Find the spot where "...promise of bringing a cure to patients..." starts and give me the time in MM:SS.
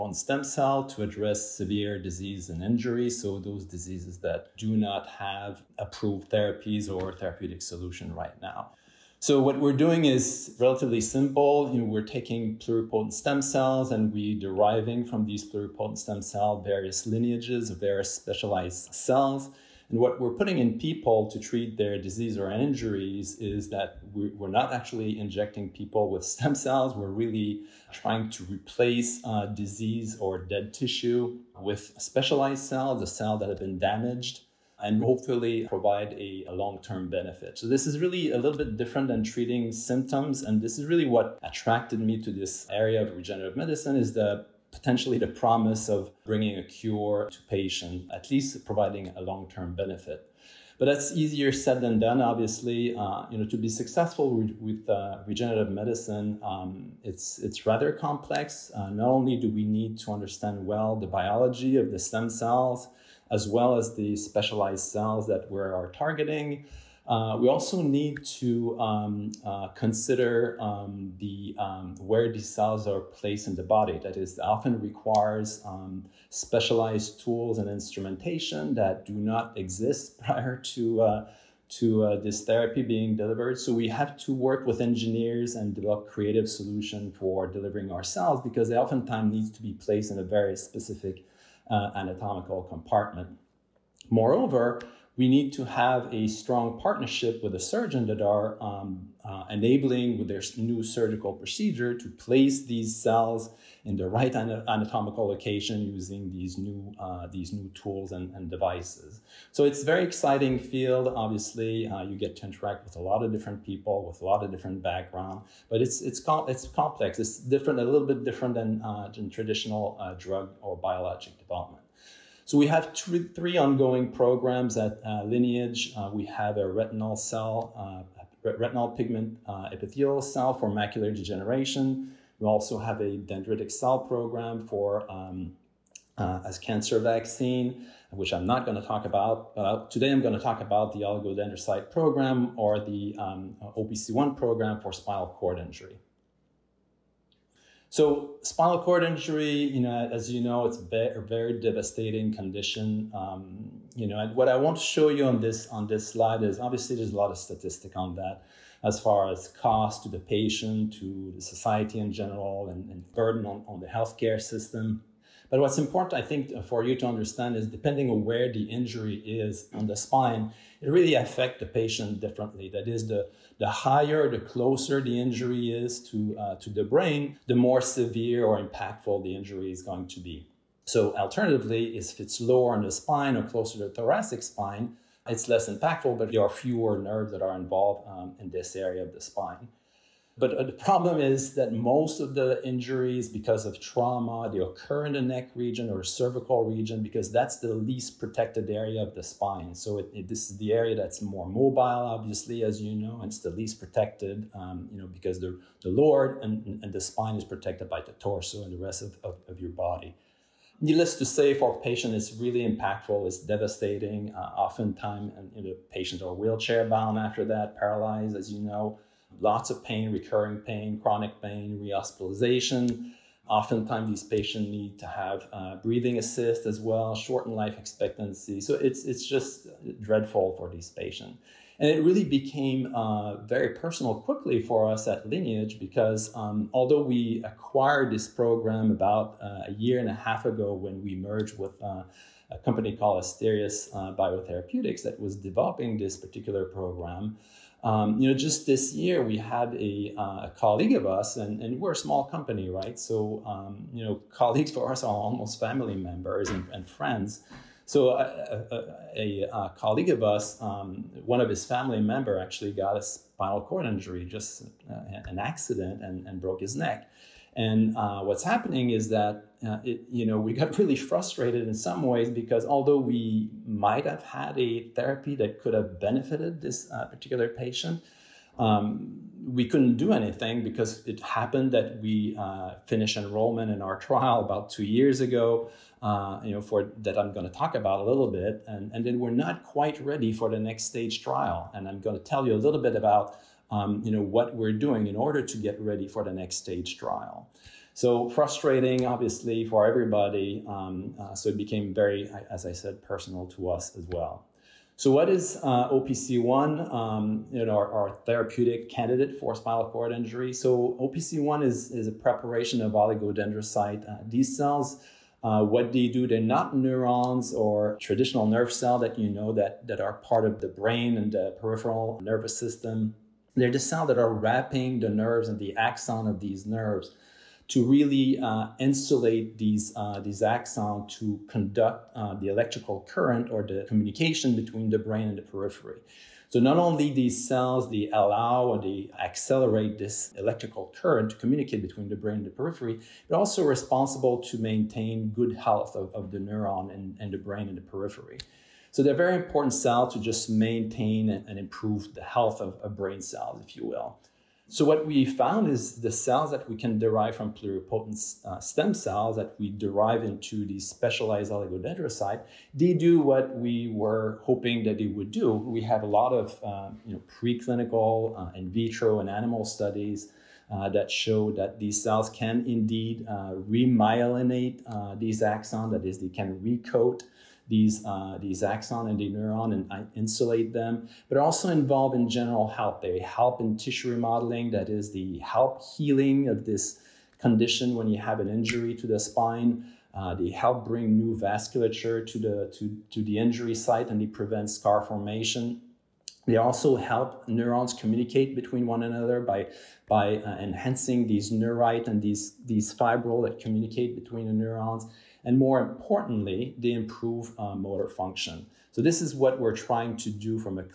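00:45.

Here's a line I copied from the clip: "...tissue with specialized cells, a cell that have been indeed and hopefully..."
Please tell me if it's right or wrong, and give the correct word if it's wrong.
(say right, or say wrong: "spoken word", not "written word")
wrong: "damaged", not "indeed".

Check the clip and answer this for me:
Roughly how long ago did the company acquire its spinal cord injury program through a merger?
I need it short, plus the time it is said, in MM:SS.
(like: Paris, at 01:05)
a year and a half, at 03:59.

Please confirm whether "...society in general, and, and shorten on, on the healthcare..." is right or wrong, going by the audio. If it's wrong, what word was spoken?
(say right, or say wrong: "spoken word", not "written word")
wrong: "burden", not "shorten".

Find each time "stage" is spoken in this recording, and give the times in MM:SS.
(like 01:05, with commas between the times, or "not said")
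04:50, 04:56.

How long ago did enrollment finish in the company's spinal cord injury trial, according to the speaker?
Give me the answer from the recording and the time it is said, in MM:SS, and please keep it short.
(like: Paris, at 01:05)
about 2 years ago, at 04:44.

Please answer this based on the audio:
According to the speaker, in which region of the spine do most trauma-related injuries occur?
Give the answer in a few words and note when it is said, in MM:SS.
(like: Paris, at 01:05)
cervical region, at 03:16.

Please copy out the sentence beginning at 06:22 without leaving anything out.
They help in tissue remodeling, that is the help healing of this condition when you have an injury to the spine.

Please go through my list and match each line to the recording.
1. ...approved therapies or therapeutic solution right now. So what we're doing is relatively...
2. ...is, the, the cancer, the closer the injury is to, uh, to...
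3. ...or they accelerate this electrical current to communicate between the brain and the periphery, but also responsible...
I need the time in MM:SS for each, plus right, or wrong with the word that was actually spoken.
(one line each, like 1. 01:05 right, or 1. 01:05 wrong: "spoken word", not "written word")
1. 00:05 right
2. 02:52 wrong: "higher", not "cancer"
3. 05:38 right.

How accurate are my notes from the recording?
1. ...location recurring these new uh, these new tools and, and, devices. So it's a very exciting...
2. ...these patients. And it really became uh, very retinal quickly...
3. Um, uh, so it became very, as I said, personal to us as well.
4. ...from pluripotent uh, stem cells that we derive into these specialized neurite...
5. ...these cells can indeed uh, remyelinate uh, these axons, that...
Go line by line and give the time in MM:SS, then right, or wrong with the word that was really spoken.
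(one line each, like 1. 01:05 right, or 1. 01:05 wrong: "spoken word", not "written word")
1. 01:45 wrong: "using", not "recurring"
2. 03:50 wrong: "personal", not "retinal"
3. 05:00 right
4. 05:57 wrong: "oligodendrocyte", not "neurite"
5. 06:11 right.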